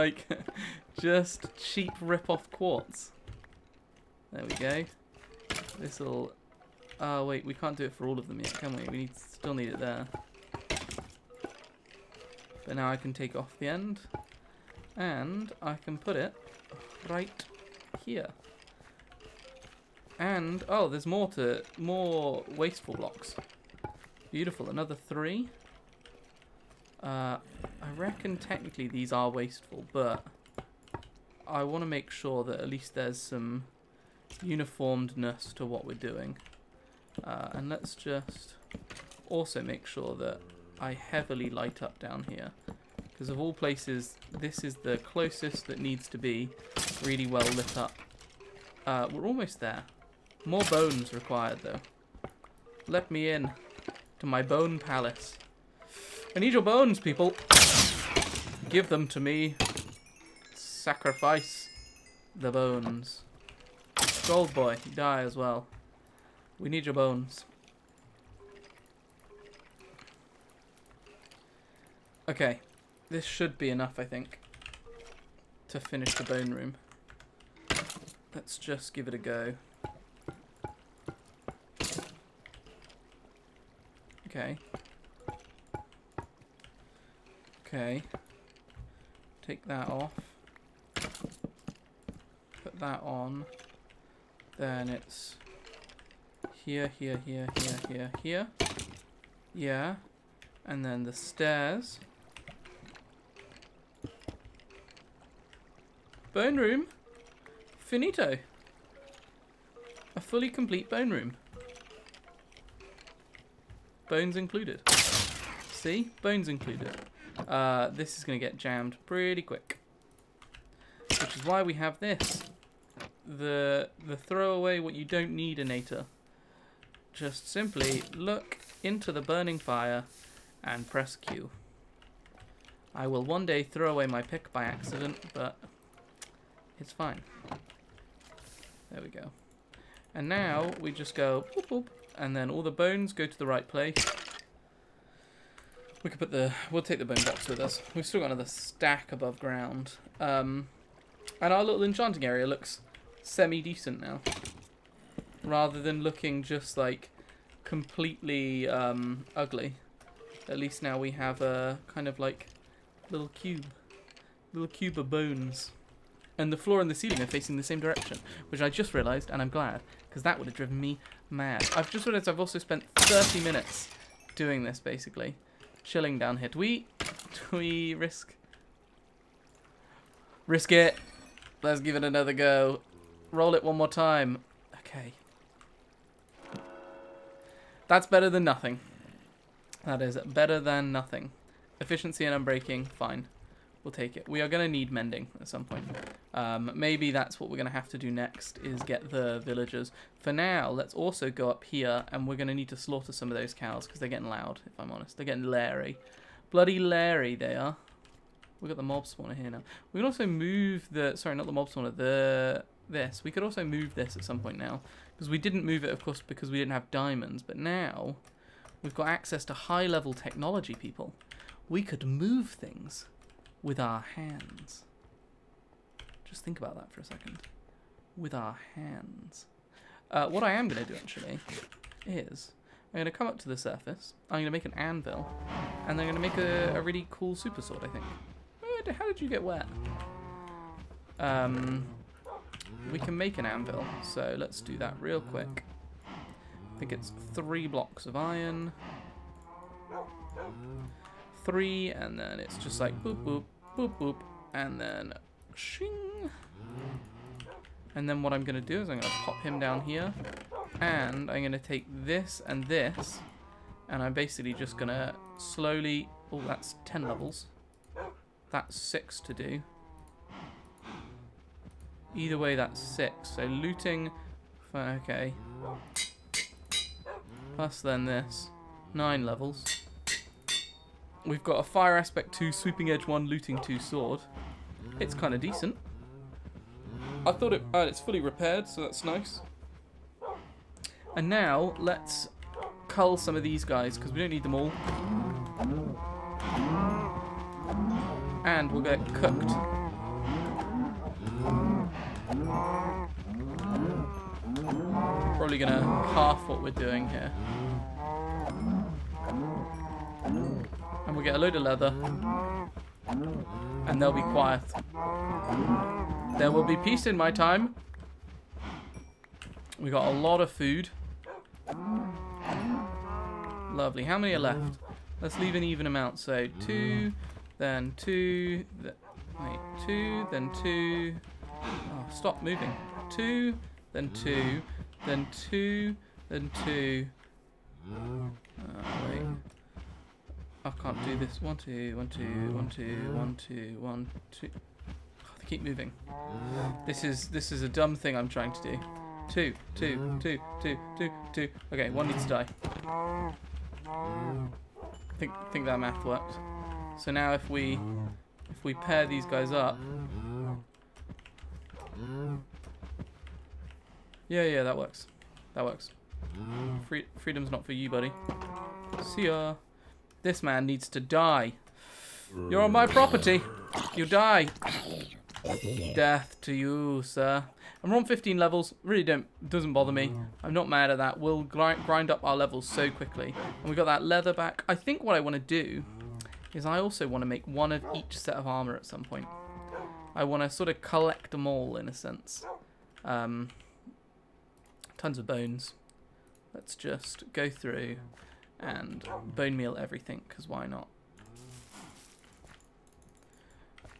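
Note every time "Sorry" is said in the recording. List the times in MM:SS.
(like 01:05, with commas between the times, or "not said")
03:31.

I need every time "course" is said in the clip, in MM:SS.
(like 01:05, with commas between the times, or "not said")
03:36.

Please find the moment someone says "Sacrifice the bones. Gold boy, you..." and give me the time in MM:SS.
01:00.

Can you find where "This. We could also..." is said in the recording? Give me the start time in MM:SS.
03:32.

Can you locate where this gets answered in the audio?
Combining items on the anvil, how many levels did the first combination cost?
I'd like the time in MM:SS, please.
04:26.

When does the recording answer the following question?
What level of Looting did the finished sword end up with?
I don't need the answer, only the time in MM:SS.
04:43.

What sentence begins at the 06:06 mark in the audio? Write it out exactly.
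Free freedom's not for you, buddy.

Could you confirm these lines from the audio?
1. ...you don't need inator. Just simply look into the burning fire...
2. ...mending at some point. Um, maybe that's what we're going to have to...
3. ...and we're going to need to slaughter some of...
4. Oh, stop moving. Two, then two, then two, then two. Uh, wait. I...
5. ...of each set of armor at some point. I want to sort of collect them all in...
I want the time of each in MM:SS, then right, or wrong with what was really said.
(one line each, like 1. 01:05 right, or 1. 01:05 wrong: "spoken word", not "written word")
1. 02:04 right
2. 03:14 right
3. 03:22 right
4. 05:31 right
5. 06:27 right.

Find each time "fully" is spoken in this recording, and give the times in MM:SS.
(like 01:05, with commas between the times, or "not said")
01:50, 04:47.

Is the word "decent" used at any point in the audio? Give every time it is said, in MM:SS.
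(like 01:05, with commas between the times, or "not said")
02:33, 04:45.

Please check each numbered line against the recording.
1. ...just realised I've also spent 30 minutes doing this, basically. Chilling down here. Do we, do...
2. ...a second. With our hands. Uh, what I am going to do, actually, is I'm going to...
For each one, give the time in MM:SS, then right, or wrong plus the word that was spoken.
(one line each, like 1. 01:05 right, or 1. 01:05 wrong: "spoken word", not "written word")
1. 02:51 right
2. 03:46 right.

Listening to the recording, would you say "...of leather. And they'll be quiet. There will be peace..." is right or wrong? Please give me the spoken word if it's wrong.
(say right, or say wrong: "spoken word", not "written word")
right.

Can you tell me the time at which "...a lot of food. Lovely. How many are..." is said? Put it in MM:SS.
05:20.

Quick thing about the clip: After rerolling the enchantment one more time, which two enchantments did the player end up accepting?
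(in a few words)
Efficiency and Unbreaking.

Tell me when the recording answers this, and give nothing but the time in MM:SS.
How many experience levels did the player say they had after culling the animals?
06:18.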